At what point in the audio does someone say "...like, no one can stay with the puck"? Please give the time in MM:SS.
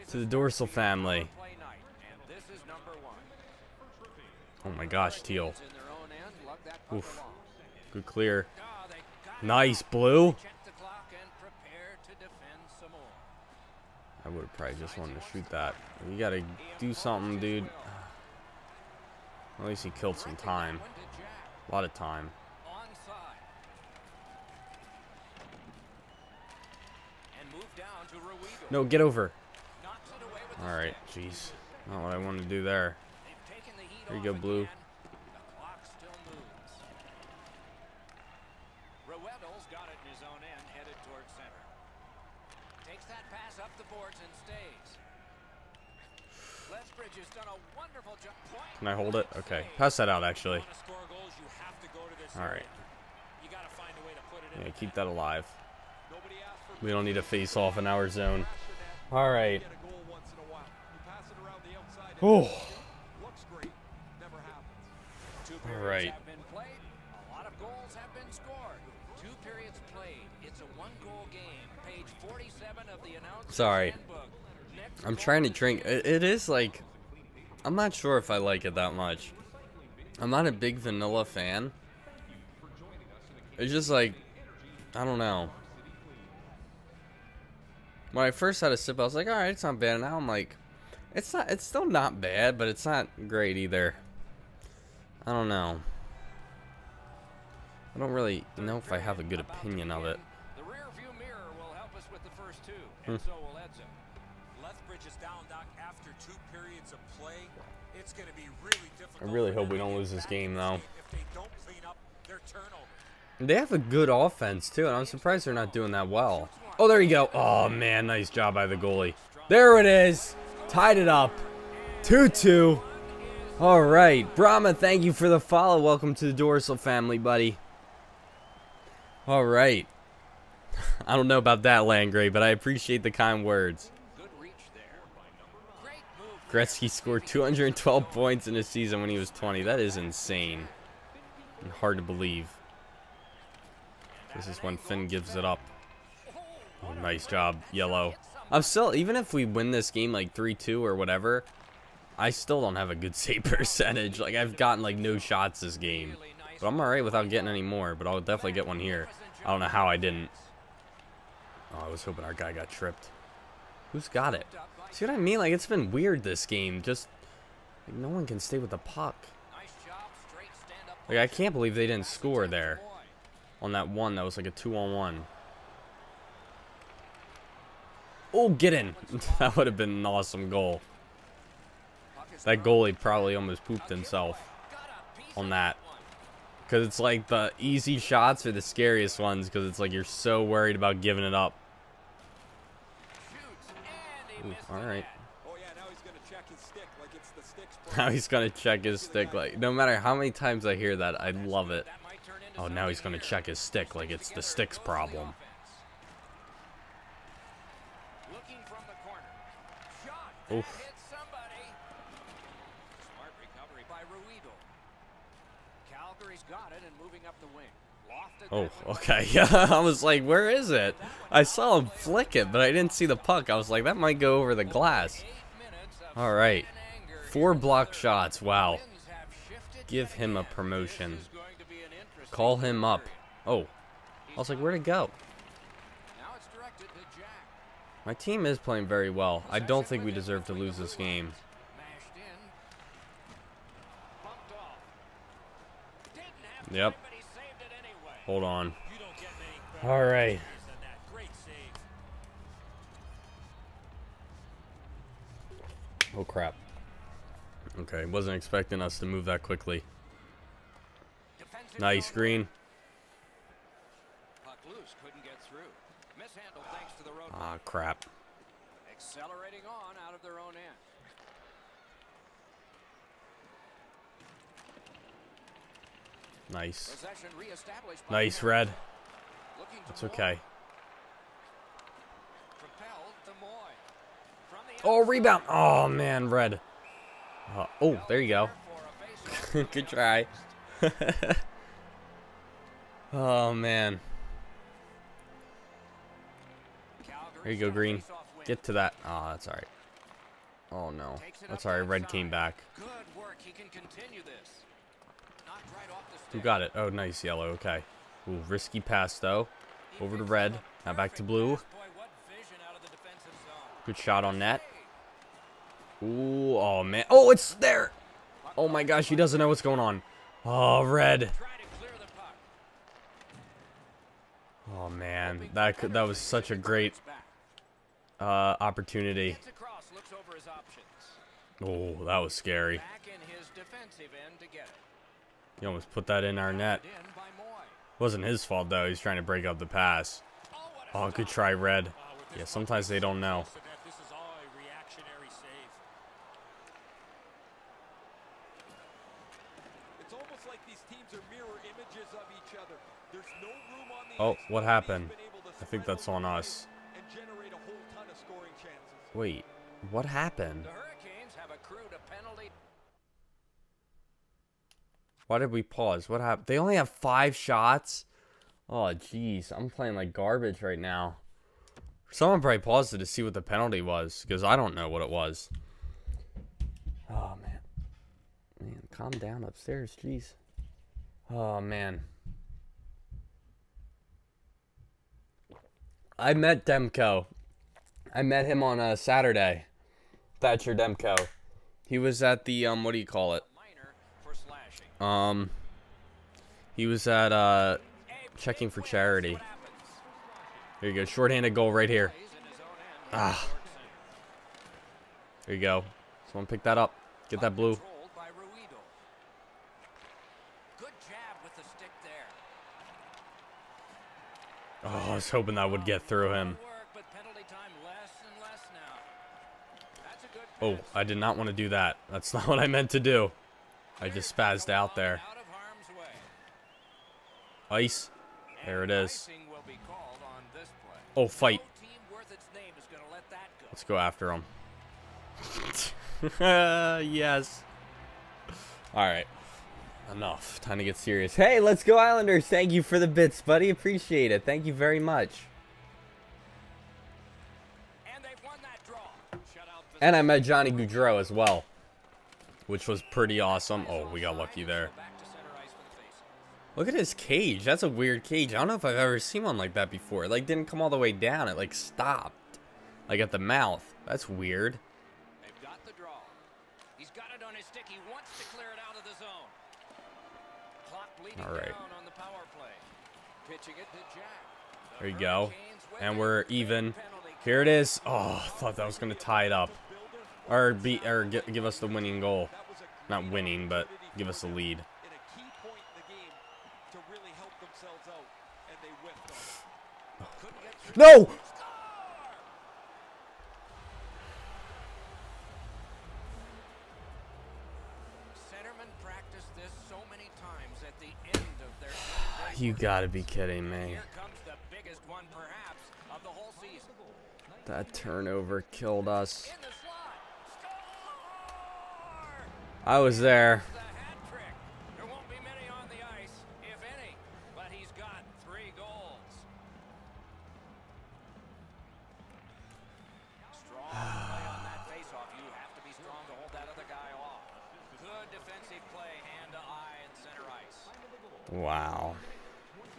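02:47.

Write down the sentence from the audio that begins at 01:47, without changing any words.
It's going to be really difficult.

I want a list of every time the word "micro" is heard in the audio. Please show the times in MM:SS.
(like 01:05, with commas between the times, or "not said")
not said.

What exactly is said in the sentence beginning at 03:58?
My team is playing very well.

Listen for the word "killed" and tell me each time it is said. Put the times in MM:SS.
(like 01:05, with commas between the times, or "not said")
00:19, 08:28.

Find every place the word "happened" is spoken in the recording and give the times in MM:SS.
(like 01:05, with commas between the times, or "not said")
05:54, 06:00, 06:06.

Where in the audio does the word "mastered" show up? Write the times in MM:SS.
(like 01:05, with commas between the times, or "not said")
not said.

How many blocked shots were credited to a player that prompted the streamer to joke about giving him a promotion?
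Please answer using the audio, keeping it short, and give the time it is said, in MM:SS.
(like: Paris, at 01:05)
4, at 03:47.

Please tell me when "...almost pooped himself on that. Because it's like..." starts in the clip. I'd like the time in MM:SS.
03:03.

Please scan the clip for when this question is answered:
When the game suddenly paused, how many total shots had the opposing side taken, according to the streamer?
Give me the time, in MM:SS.
06:06.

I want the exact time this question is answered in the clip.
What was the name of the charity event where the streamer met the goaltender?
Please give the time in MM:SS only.
06:38.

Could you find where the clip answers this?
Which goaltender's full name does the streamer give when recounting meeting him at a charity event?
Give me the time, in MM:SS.
06:30.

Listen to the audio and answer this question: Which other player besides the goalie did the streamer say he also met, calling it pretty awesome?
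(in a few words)
Johnny Gaudreau.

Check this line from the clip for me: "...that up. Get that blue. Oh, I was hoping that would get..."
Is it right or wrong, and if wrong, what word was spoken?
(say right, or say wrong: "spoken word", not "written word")
right.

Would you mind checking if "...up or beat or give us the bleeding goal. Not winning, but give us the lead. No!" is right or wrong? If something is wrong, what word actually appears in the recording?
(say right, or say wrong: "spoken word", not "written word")
wrong: "winning", not "bleeding".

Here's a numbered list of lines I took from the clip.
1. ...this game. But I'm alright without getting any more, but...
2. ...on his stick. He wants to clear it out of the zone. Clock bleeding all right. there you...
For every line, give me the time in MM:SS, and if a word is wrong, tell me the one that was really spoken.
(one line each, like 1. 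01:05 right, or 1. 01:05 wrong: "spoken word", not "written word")
1. 02:35 right
2. 07:47 right.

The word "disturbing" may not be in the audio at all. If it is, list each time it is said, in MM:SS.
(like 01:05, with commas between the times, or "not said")
not said.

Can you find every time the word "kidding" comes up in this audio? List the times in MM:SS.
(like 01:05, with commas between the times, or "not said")
08:23.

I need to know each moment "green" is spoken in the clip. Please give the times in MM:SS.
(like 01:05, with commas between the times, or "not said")
04:22, 04:57.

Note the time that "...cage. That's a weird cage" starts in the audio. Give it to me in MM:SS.
07:37.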